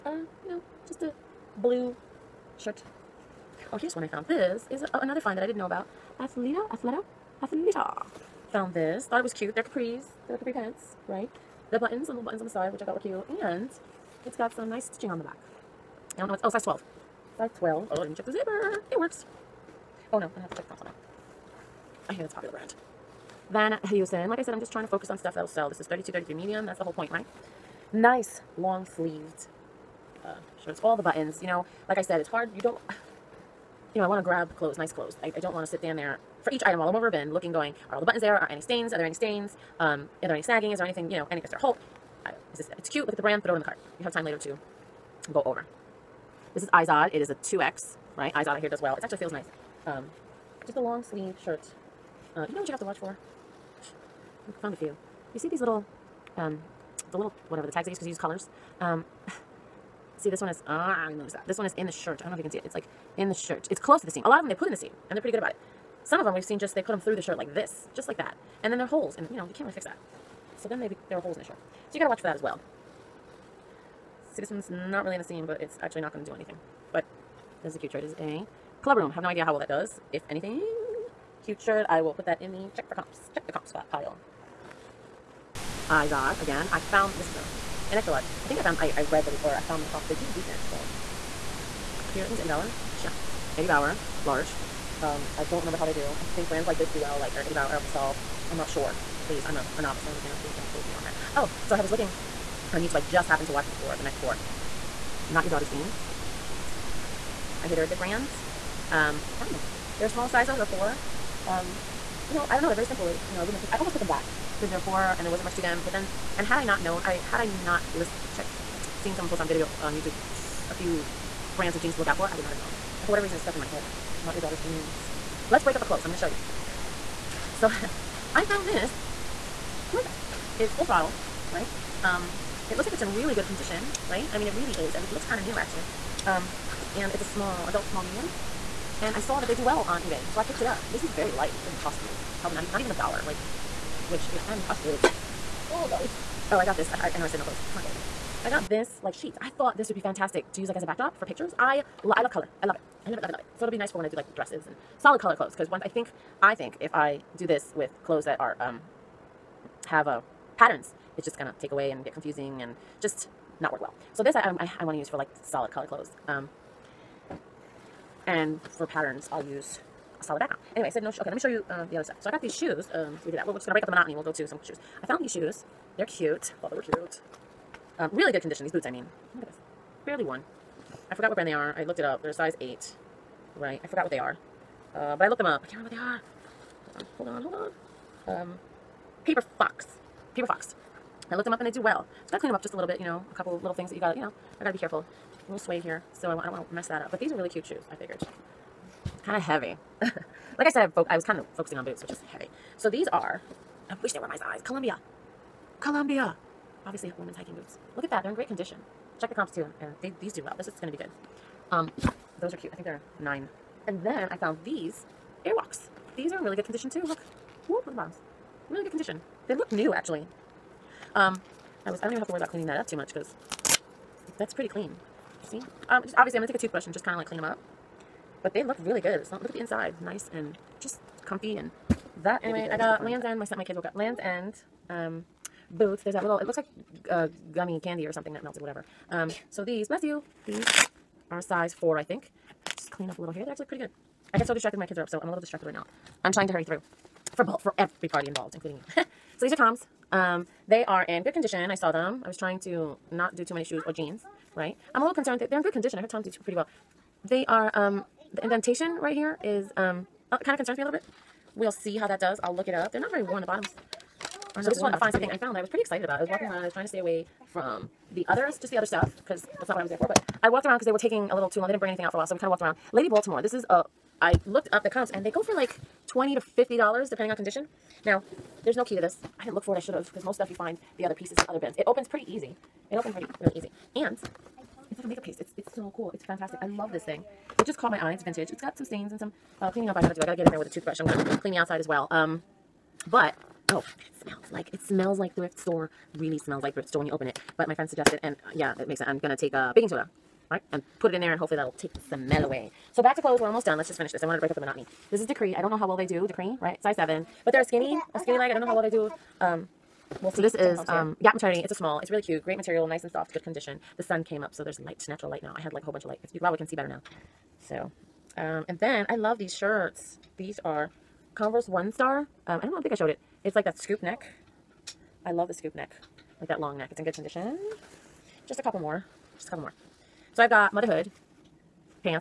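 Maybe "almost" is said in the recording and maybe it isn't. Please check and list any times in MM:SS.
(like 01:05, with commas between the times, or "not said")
01:53, 05:03.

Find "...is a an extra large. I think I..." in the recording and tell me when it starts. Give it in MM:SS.
01:27.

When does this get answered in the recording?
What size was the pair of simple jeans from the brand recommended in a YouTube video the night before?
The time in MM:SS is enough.
01:50.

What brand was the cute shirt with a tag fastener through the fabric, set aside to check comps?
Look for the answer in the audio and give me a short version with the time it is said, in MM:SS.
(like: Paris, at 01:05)
Club Room, at 01:18.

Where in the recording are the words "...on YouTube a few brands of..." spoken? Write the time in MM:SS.
01:59.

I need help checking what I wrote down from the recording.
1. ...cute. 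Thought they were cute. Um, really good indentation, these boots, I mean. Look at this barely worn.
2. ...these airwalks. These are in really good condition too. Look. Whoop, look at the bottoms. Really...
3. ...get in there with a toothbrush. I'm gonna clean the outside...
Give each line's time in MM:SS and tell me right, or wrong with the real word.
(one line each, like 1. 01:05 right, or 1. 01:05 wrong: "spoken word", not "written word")
1. 02:56 wrong: "condition", not "indentation"
2. 03:34 right
3. 04:50 right.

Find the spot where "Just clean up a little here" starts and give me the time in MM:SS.
04:02.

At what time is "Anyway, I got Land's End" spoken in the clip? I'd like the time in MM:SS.
03:52.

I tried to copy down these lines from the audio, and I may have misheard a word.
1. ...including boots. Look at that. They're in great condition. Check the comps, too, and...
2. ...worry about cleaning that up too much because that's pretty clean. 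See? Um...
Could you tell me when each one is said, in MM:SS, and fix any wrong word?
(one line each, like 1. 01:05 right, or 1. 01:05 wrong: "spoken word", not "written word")
1. 03:27 wrong: "hiking", not "including"
2. 03:42 right.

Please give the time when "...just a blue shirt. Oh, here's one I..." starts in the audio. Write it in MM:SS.
00:00.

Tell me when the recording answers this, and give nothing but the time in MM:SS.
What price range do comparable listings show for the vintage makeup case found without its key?
04:36.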